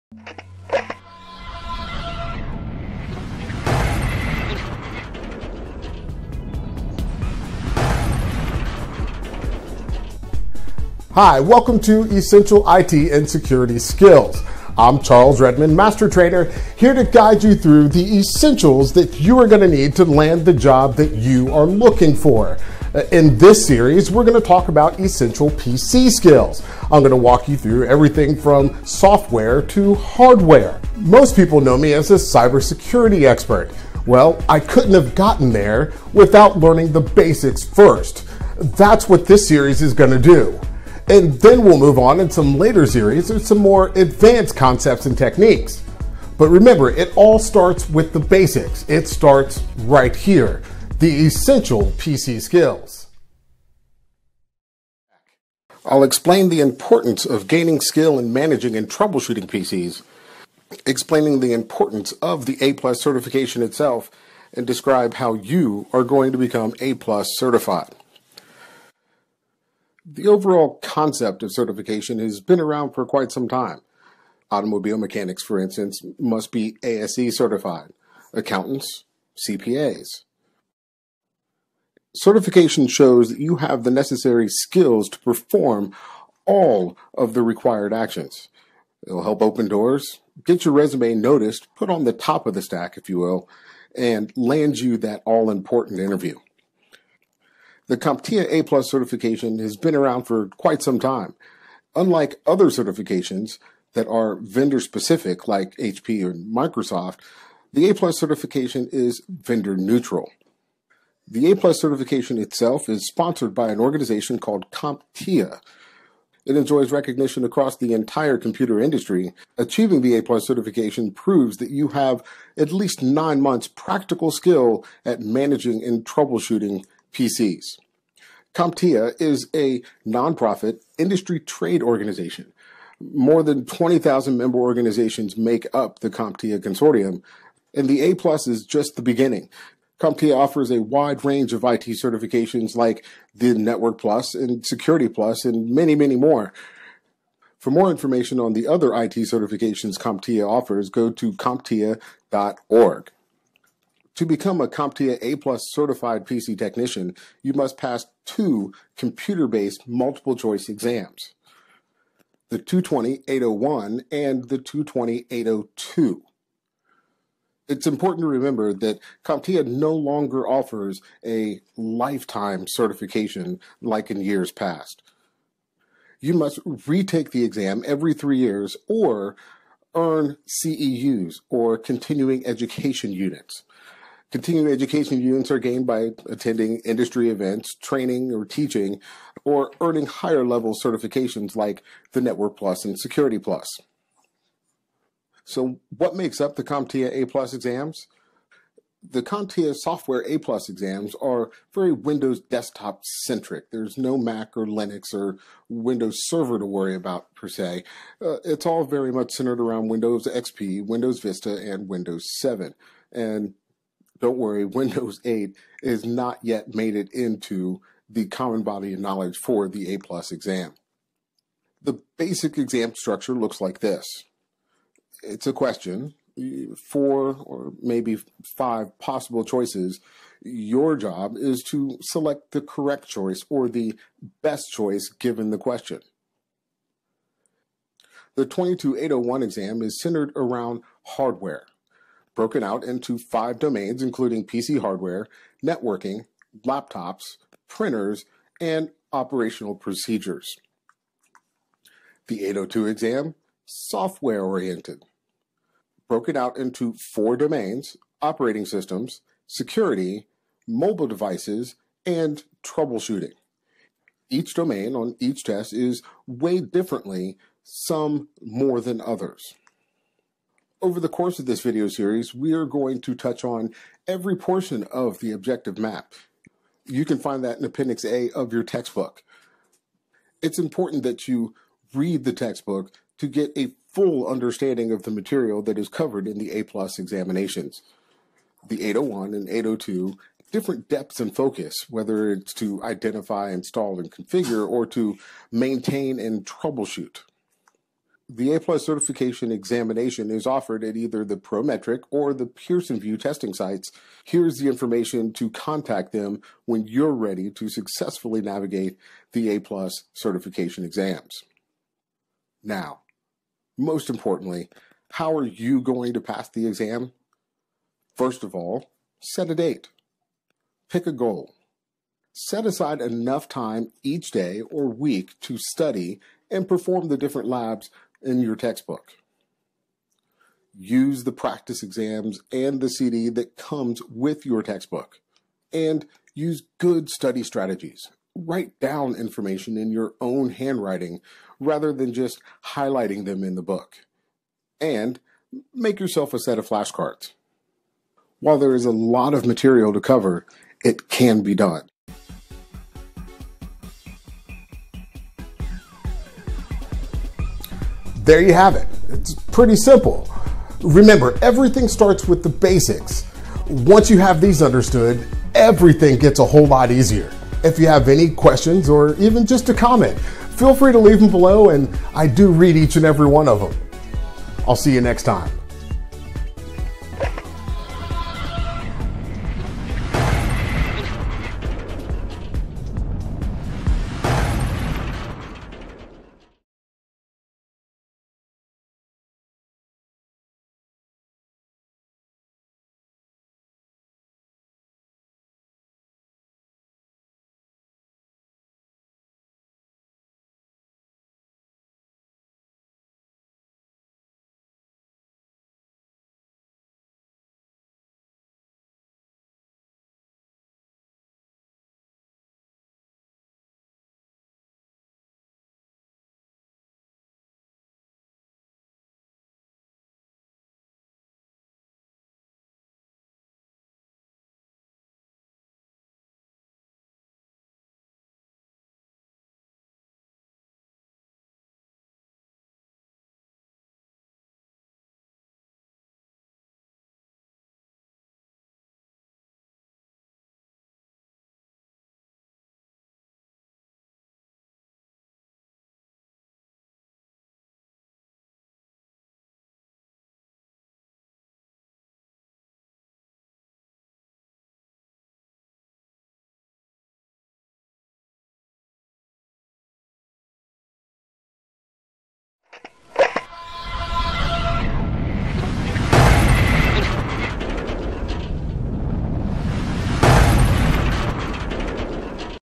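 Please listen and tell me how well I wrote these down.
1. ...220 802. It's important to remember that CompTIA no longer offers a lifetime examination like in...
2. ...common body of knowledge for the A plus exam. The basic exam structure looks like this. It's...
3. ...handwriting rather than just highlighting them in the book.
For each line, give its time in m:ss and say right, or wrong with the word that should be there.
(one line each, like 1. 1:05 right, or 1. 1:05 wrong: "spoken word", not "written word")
1. 2:44 wrong: "certification", not "examination"
2. 3:38 right
3. 5:40 right.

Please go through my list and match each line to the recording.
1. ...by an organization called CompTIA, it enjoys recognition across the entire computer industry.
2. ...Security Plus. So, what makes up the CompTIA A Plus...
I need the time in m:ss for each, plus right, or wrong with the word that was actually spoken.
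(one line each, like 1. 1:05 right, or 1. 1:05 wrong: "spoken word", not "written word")
1. 1:53 right
2. 3:12 right.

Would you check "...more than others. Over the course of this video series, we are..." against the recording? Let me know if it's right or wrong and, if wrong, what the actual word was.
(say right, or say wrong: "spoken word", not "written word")
right.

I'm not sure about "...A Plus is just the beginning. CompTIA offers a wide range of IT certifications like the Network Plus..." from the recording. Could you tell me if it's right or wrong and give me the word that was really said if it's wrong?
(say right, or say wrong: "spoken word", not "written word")
right.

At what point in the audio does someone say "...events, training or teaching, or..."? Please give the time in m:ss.
3:07.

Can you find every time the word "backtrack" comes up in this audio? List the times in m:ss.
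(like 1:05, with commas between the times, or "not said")
not said.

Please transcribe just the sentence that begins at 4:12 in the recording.
The 802 exam, software oriented, broken out into four domains operating systems, security, mobile devices, and troubleshooting.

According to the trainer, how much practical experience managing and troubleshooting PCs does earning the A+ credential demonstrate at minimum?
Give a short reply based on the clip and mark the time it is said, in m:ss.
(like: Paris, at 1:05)
9 months, at 2:03.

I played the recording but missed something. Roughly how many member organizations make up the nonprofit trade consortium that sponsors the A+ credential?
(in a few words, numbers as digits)
More than 20,000.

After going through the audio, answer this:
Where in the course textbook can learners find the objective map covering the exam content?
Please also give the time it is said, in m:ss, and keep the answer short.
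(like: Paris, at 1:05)
Appendix A, at 4:37.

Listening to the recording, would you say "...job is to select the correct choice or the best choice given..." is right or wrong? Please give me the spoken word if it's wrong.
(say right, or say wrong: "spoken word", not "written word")
right.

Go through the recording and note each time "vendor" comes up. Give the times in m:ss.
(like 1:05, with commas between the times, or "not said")
1:44, 1:49.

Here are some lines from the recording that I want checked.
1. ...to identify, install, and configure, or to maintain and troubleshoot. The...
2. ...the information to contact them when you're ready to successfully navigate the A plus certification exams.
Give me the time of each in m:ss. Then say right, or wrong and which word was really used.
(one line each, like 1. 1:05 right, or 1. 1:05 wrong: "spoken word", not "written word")
1. 4:52 right
2. 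5:04 right.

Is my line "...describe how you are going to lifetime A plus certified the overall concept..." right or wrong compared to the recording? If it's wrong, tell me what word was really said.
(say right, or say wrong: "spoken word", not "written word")
wrong: "become", not "lifetime".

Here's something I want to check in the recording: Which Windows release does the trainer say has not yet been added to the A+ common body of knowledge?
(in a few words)
Windows 8.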